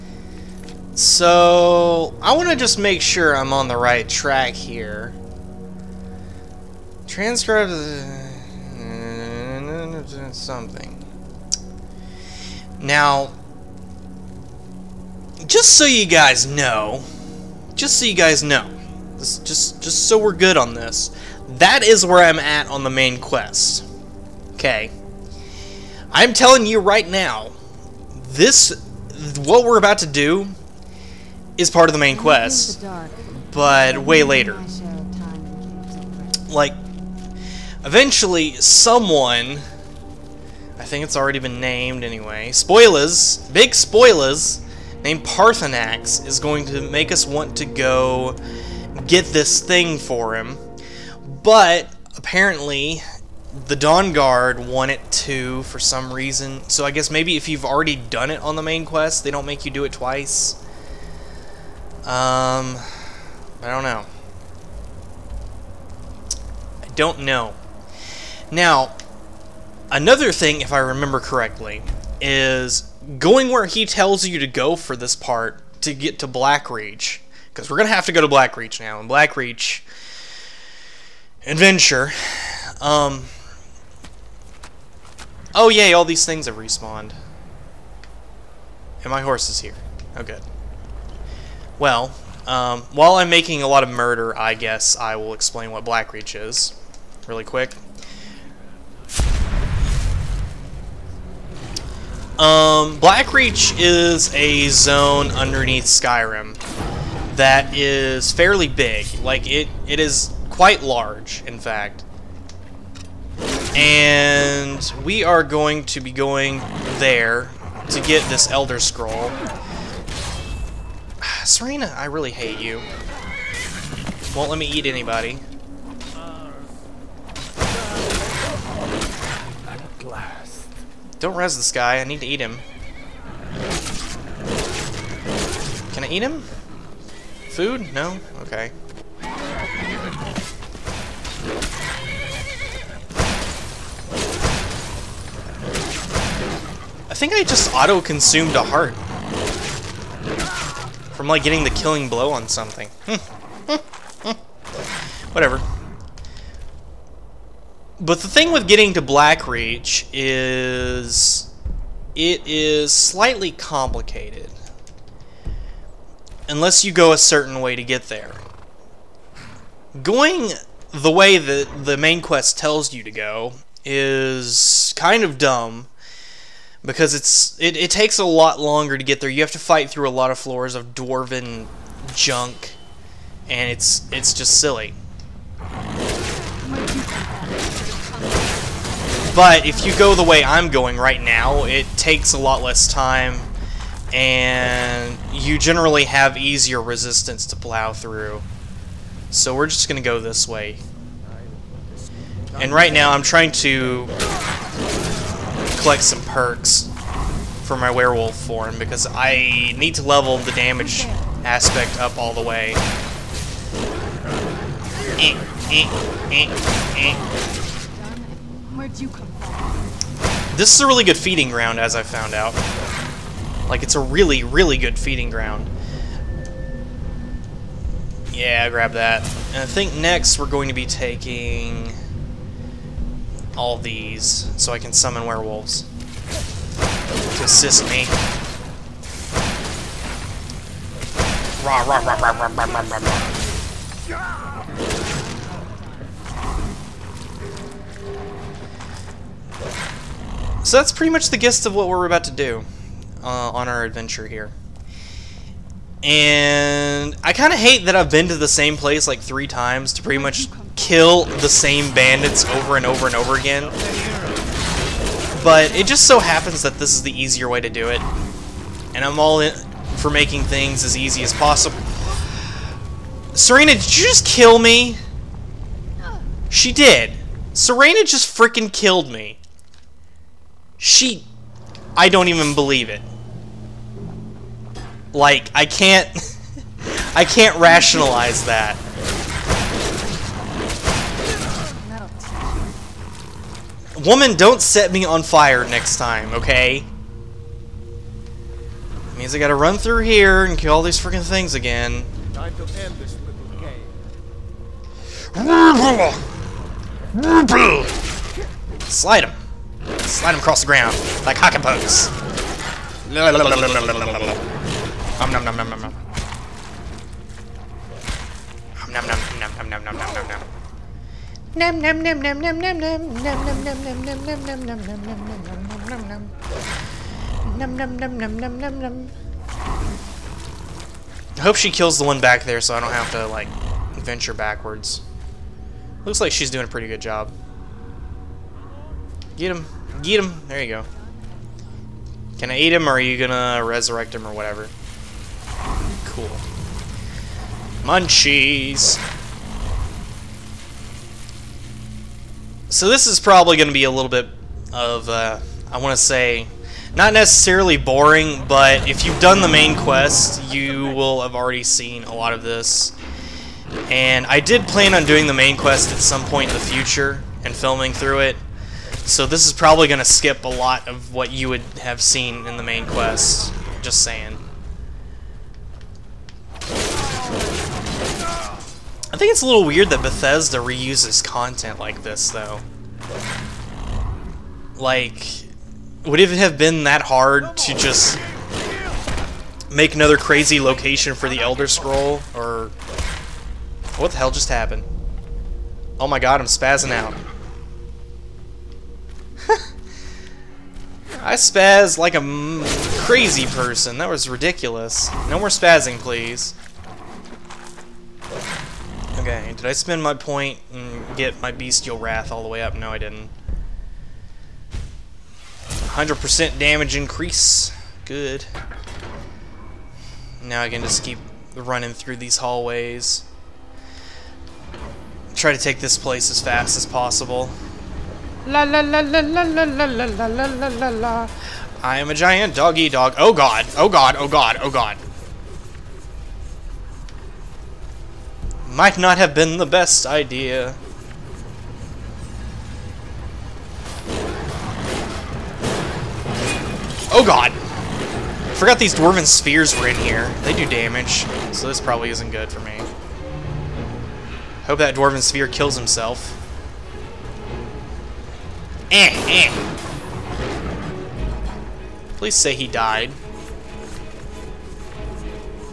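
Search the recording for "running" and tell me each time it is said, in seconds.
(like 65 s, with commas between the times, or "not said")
421 s.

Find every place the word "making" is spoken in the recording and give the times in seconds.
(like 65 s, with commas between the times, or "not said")
93 s, 270 s.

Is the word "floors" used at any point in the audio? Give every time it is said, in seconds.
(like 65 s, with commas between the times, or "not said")
180 s.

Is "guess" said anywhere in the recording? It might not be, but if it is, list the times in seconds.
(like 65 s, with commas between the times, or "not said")
56 s, 94 s.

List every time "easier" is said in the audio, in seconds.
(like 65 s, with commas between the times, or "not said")
196 s, 267 s.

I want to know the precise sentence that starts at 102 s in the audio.
Um, Blackreach is a zone underneath Skyrim that is fairly big.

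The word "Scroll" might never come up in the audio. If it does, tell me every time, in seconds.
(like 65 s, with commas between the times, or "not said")
118 s, 391 s.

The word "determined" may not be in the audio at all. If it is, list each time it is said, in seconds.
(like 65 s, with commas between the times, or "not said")
not said.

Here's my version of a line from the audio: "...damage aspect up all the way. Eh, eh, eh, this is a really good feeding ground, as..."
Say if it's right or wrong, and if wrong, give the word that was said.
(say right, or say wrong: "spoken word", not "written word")
right.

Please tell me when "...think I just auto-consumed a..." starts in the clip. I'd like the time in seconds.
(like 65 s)
147 s.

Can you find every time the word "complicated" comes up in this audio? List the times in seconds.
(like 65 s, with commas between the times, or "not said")
163 s.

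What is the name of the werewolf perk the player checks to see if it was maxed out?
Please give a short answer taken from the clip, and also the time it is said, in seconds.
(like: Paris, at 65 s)
Bestial Wrath, at 411 s.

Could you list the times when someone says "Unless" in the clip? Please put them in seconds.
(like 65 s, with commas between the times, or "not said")
166 s.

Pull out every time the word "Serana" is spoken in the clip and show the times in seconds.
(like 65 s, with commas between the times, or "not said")
121 s, 273 s, 277 s.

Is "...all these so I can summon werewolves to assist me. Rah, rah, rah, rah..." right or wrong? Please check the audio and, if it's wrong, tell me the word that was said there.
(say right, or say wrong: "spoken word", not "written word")
right.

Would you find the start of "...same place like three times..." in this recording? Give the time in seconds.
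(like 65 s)
258 s.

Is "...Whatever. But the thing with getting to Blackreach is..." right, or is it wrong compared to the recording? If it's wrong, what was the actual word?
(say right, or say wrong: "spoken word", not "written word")
right.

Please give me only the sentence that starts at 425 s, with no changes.
Try to take this place as fast as possible.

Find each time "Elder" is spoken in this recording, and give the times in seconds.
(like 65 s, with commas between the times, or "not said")
118 s, 391 s.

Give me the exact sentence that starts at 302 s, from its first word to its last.
Time to end this little game.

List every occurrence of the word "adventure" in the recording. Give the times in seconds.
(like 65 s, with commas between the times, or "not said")
81 s, 253 s.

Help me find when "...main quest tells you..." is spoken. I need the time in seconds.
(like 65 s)
171 s.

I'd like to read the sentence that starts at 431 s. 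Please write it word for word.
I am a giant doggy dog.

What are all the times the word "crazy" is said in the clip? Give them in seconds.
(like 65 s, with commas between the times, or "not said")
390 s, 403 s.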